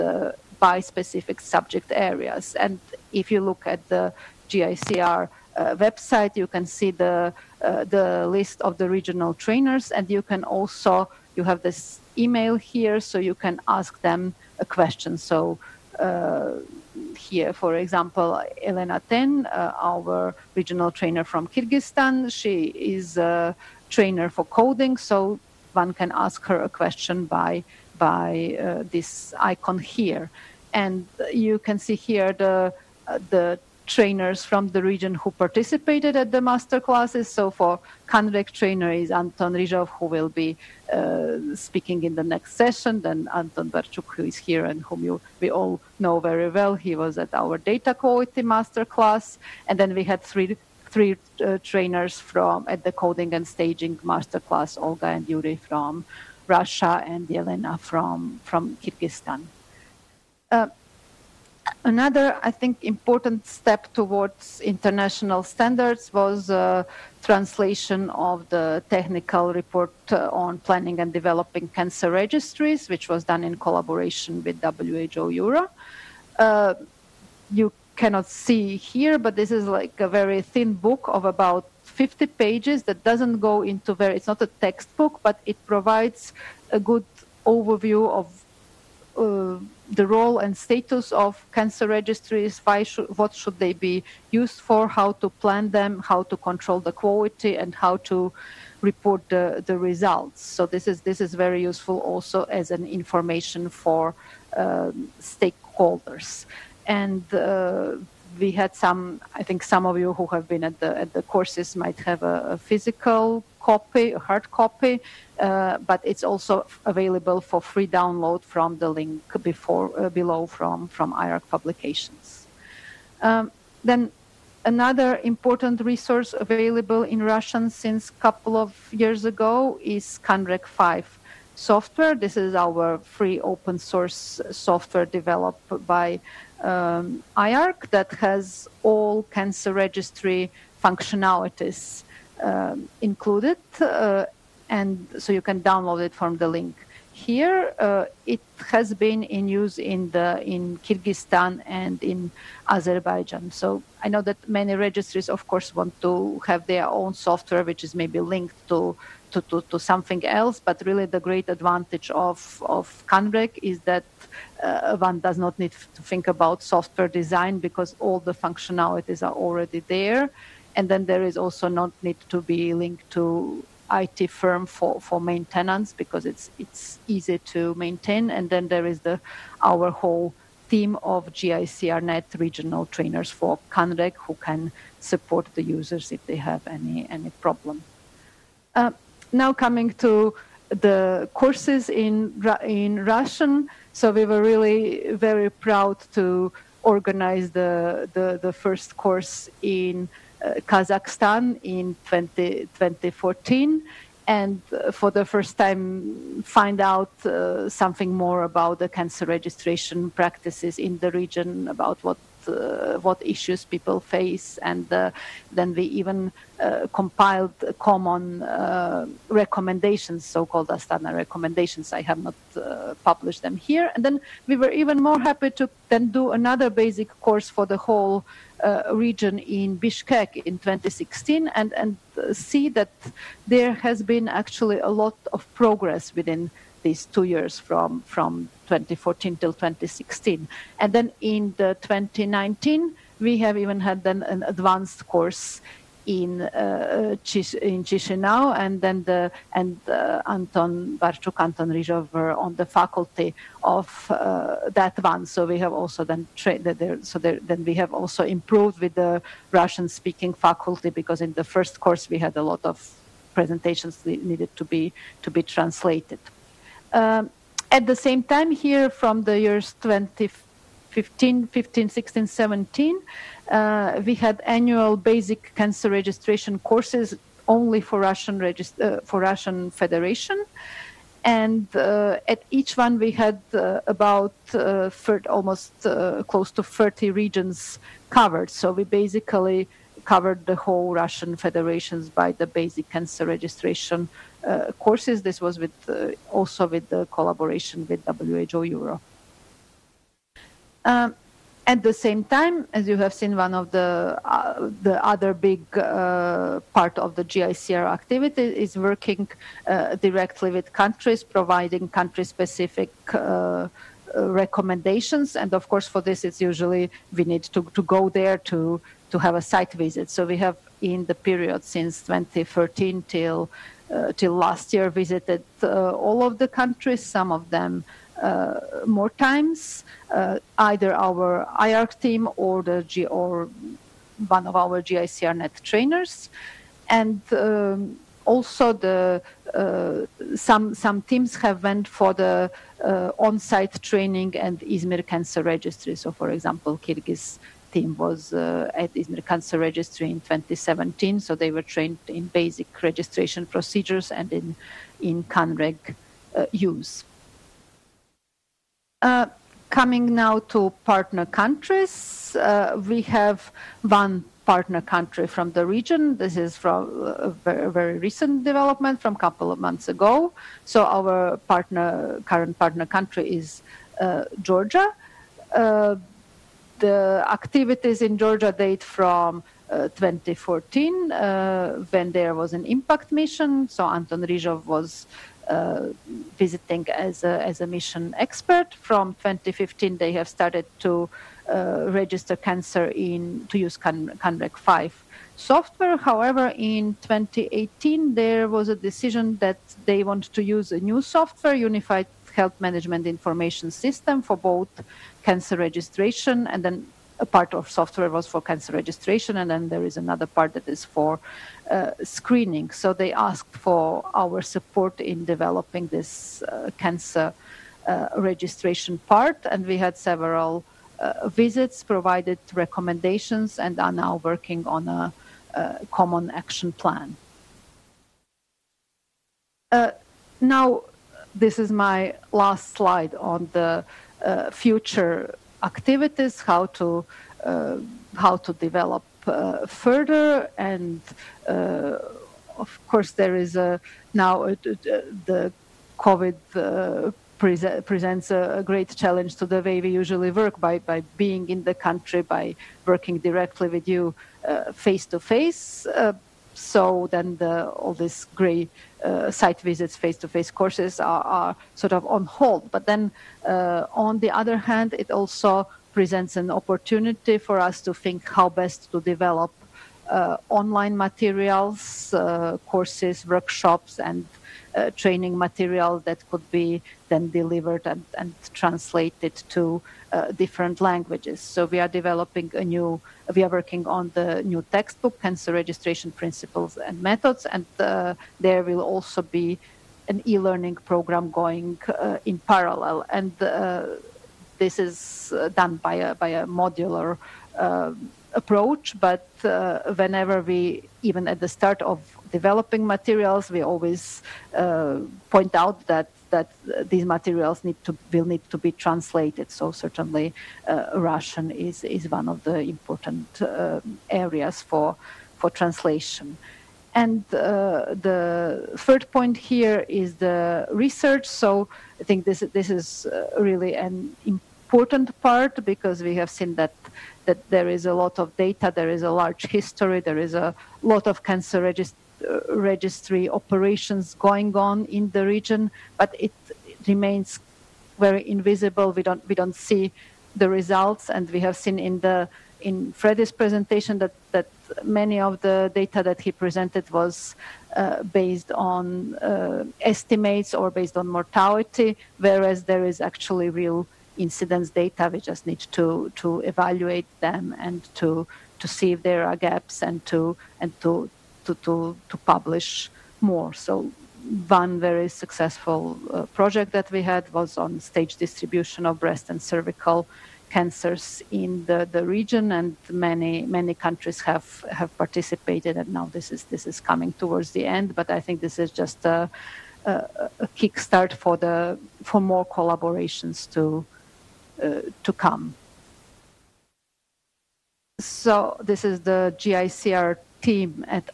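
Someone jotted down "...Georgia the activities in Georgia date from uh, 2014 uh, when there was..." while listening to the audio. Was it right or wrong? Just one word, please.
right.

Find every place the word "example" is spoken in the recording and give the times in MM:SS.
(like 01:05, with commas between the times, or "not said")
00:17, 05:46.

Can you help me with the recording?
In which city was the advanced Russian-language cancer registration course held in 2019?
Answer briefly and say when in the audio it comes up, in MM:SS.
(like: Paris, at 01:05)
Chisinau, at 04:07.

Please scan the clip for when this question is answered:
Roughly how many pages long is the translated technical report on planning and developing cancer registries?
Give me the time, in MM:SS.
01:21.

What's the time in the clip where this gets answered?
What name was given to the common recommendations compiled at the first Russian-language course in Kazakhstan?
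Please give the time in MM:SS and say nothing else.
03:40.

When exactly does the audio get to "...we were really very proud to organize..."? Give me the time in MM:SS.
03:14.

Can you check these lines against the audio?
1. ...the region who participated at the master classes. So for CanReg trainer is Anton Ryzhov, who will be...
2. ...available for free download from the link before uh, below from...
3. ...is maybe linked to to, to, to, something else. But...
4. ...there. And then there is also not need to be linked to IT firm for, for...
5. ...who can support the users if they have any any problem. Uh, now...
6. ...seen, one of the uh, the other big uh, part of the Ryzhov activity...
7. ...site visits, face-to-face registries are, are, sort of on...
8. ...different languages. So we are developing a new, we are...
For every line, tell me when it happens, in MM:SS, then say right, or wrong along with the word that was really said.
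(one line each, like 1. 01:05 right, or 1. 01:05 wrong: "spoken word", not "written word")
1. 00:34 right
2. 01:56 right
3. 02:37 right
4. 02:49 right
5. 03:04 right
6. 05:03 wrong: "GICR", not "Ryzhov"
7. 07:39 wrong: "courses", not "registries"
8. 08:00 right.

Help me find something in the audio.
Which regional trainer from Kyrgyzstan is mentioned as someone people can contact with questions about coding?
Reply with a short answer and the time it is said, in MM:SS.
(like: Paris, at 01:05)
Elena Ten, at 00:18.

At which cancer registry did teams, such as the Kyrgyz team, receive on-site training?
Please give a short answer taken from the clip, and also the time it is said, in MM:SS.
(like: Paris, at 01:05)
Izmir Cancer Registry, at 05:44.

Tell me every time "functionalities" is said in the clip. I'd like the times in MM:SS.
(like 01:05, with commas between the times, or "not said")
02:20, 02:48.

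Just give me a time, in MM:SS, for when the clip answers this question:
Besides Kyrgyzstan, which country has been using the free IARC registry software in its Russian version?
02:32.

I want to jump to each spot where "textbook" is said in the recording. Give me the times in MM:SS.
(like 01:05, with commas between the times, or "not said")
01:24, 08:04.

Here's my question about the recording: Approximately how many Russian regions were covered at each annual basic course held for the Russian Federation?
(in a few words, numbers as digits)
30.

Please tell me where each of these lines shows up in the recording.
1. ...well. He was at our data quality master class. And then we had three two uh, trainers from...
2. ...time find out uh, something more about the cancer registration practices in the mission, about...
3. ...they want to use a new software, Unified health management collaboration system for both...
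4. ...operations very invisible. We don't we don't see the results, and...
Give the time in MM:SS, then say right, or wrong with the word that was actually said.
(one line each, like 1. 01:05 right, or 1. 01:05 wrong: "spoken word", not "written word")
1. 00:46 wrong: "three", not "two"
2. 03:25 wrong: "region", not "mission"
3. 06:39 wrong: "information", not "collaboration"
4. 08:56 wrong: "remains", not "operations".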